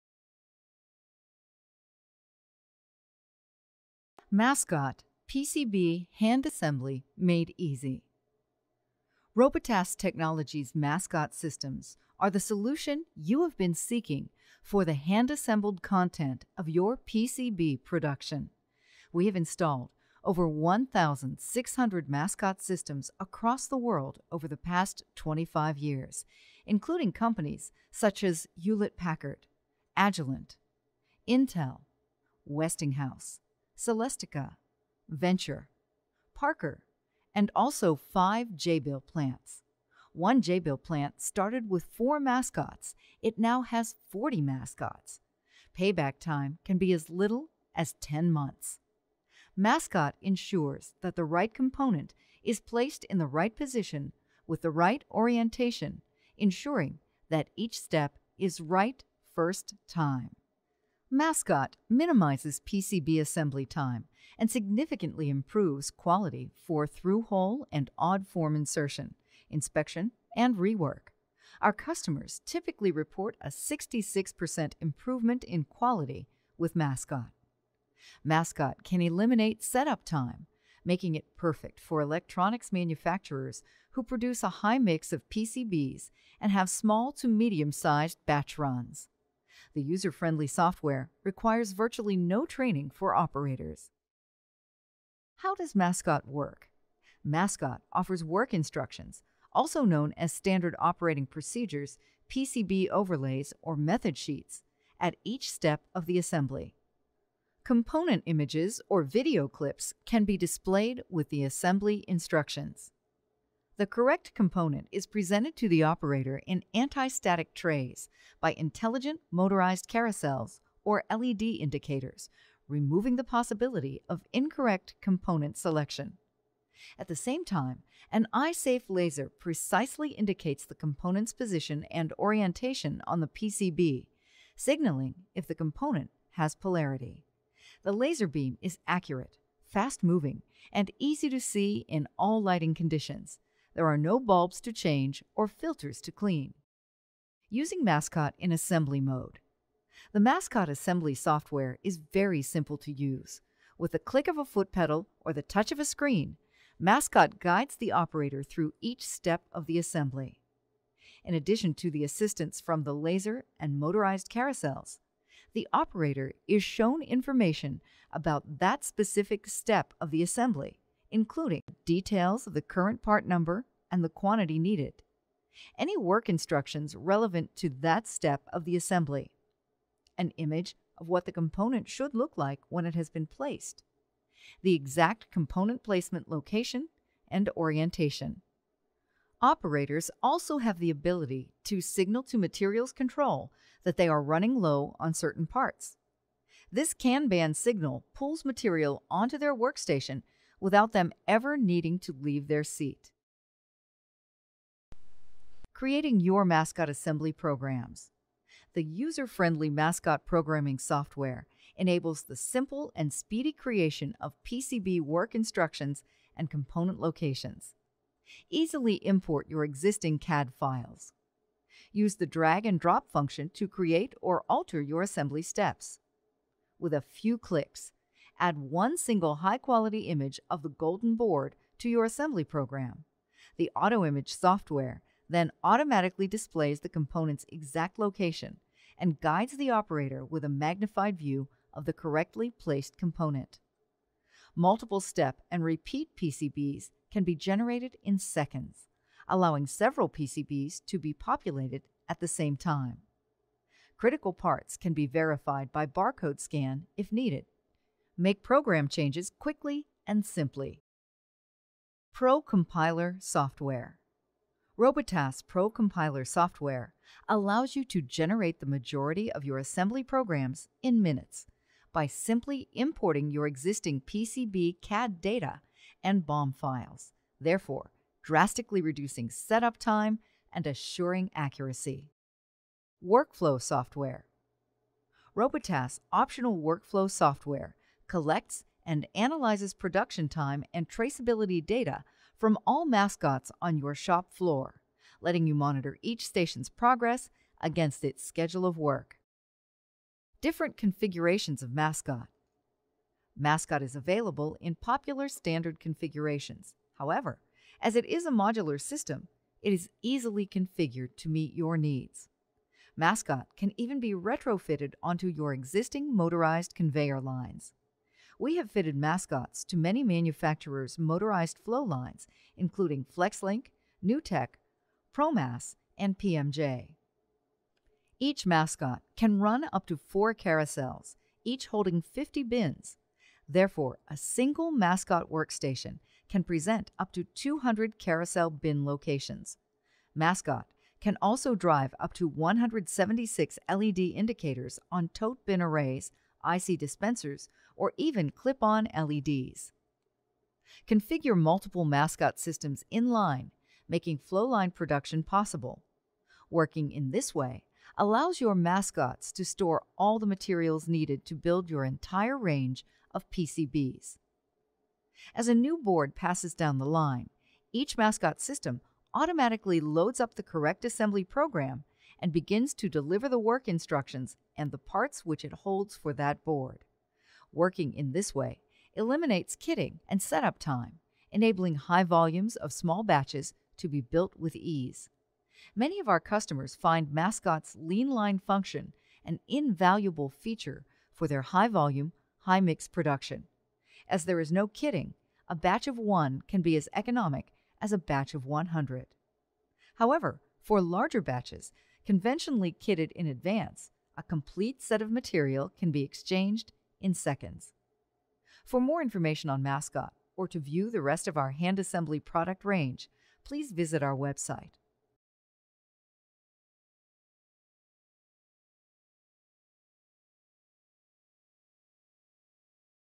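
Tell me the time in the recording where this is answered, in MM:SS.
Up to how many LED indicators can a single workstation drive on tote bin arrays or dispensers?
05:42.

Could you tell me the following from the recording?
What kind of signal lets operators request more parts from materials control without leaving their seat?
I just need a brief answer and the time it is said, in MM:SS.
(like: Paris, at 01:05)
Kanban, at 03:16.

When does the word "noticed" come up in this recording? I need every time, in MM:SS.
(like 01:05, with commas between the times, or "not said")
not said.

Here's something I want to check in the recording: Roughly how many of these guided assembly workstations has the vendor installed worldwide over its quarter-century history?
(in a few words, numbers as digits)
1,600.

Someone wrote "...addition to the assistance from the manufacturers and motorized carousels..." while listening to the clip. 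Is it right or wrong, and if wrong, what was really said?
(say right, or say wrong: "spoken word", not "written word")
wrong: "laser", not "manufacturers".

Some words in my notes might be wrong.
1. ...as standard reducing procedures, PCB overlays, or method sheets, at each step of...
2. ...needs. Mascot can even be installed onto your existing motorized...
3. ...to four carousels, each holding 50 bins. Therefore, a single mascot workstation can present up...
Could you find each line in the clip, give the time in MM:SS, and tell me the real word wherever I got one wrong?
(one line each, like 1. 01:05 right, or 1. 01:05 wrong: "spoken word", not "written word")
1. 01:40 wrong: "operating", not "reducing"
2. 05:11 wrong: "retrofitted", not "installed"
3. 05:29 right.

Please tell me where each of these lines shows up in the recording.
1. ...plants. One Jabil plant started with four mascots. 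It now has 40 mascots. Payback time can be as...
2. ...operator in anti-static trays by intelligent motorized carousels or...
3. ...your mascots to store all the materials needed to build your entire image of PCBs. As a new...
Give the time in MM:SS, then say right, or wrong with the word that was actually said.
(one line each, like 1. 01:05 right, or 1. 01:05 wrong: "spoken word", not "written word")
1. 00:39 right
2. 01:55 right
3. 05:58 wrong: "range", not "image".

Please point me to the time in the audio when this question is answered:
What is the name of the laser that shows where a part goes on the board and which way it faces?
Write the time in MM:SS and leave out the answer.
02:08.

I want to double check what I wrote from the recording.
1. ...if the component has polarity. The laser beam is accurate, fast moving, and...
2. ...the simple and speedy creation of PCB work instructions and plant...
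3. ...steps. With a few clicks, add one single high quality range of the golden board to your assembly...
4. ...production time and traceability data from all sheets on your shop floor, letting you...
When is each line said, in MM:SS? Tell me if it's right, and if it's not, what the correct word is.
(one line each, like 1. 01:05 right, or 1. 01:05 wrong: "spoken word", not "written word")
1. 02:15 right
2. 03:32 wrong: "component", not "plant"
3. 03:45 wrong: "image", not "range"
4. 04:49 wrong: "mascots", not "sheets".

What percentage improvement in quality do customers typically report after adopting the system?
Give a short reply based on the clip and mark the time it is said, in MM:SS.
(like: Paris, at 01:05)
66%, at 01:13.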